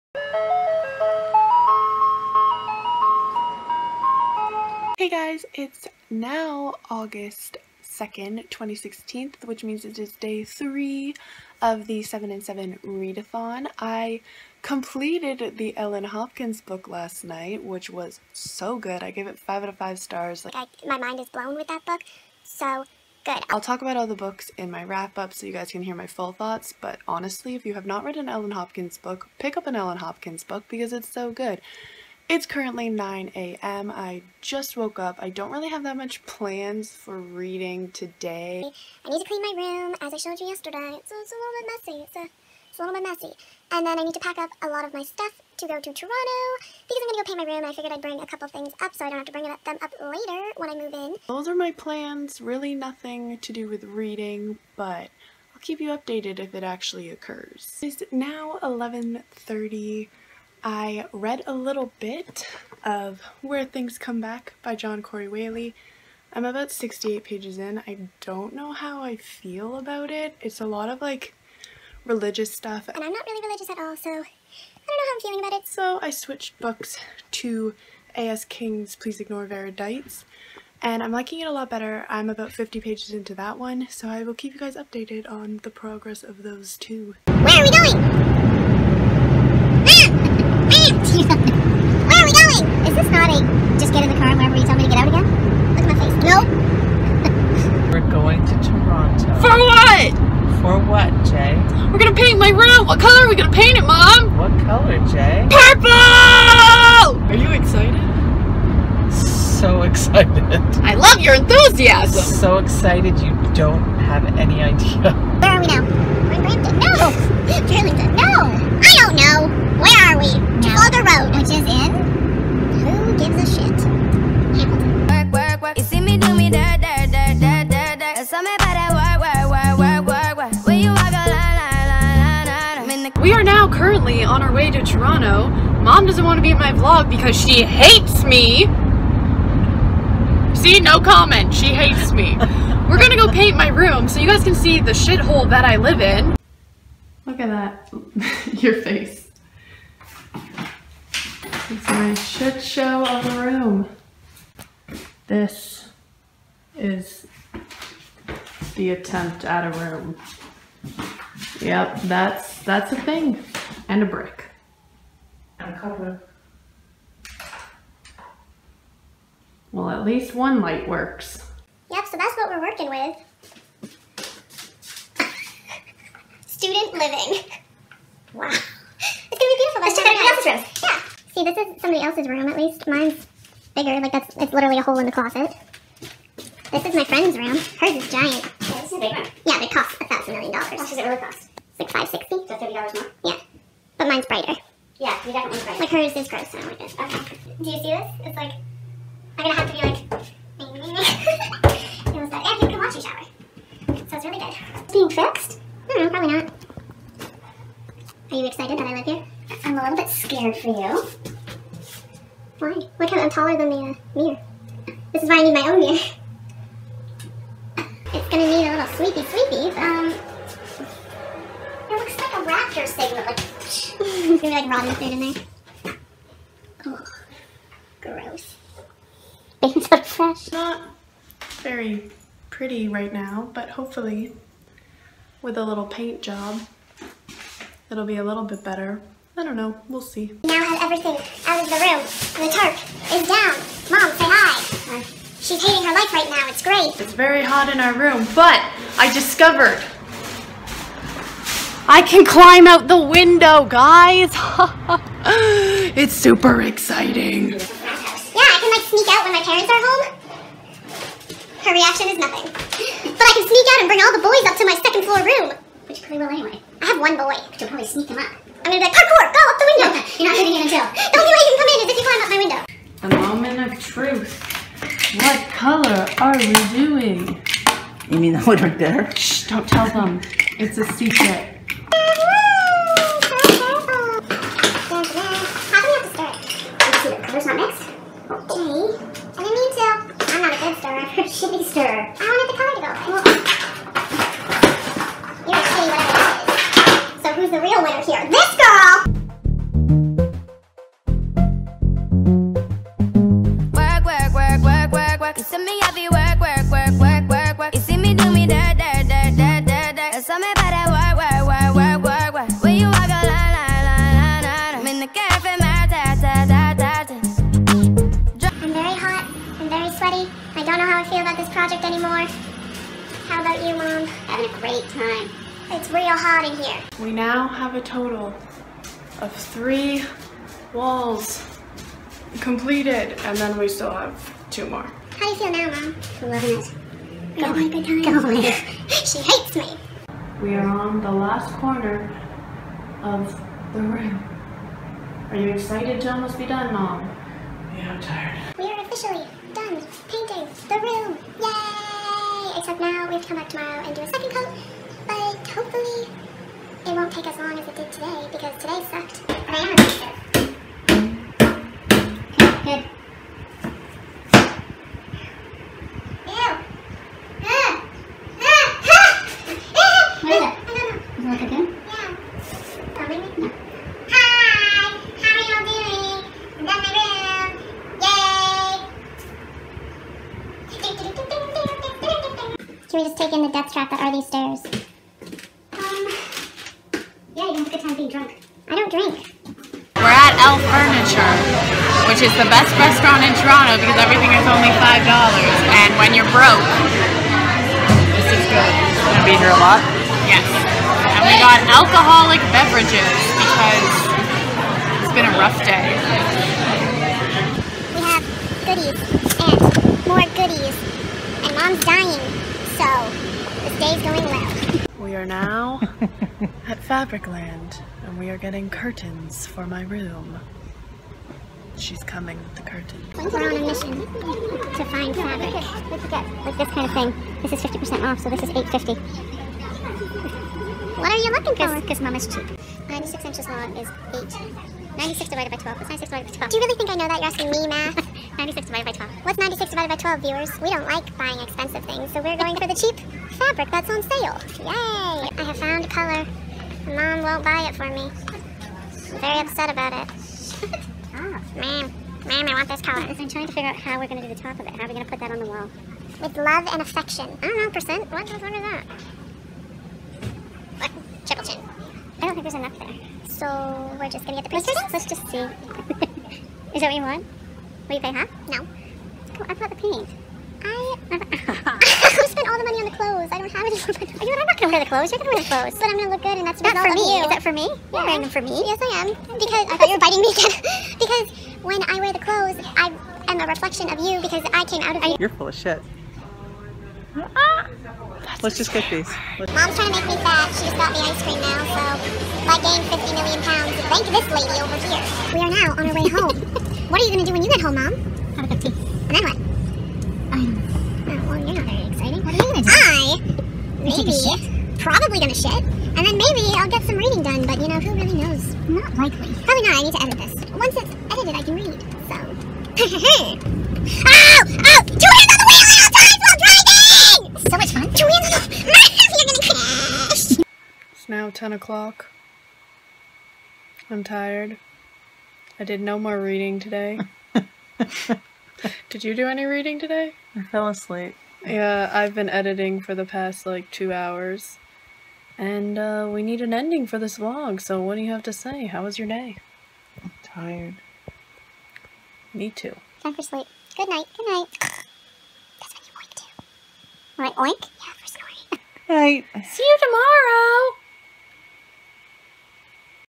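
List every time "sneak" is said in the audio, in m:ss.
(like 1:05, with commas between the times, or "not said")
4:18, 4:23, 4:27.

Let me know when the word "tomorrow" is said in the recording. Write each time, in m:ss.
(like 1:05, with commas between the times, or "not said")
5:53, 9:09.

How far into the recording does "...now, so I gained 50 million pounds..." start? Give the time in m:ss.
8:11.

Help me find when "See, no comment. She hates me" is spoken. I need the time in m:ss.
2:20.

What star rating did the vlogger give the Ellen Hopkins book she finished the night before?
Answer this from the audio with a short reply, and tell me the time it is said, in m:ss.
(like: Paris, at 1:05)
5 out of 5, at 0:19.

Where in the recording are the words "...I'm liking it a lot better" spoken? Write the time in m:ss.
1:21.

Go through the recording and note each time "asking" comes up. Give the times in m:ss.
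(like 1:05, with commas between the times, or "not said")
7:17.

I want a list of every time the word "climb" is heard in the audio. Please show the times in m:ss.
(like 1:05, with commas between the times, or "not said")
4:12, 4:32.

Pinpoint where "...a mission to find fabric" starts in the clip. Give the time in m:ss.
7:03.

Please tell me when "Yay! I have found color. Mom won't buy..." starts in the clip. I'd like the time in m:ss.
7:24.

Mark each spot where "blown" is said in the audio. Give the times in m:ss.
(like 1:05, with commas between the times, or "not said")
0:21.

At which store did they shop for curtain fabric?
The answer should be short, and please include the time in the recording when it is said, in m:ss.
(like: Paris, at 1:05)
Fabricland, at 6:56.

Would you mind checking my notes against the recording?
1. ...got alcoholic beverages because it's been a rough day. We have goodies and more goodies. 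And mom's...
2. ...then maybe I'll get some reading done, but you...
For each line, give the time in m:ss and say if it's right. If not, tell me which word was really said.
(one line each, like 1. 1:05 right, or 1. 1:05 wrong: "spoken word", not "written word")
1. 6:41 right
2. 8:26 right.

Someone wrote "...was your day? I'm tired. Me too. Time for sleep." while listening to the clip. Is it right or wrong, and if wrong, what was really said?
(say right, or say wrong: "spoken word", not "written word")
right.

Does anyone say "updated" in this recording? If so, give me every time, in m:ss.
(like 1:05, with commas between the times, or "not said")
0:55, 1:24.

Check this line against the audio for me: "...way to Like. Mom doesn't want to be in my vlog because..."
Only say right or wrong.
wrong.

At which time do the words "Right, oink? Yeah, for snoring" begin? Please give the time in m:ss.
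9:07.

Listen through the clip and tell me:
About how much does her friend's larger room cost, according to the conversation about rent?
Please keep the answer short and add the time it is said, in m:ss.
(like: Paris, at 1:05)
560, at 3:11.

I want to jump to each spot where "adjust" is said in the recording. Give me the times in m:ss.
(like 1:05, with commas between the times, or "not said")
not said.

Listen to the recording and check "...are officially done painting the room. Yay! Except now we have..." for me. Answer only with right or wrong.
right.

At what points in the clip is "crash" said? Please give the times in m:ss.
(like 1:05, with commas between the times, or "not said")
8:39.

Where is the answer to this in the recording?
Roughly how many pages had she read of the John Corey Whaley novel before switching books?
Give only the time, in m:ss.
1:06.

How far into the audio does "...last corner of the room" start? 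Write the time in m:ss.
5:41.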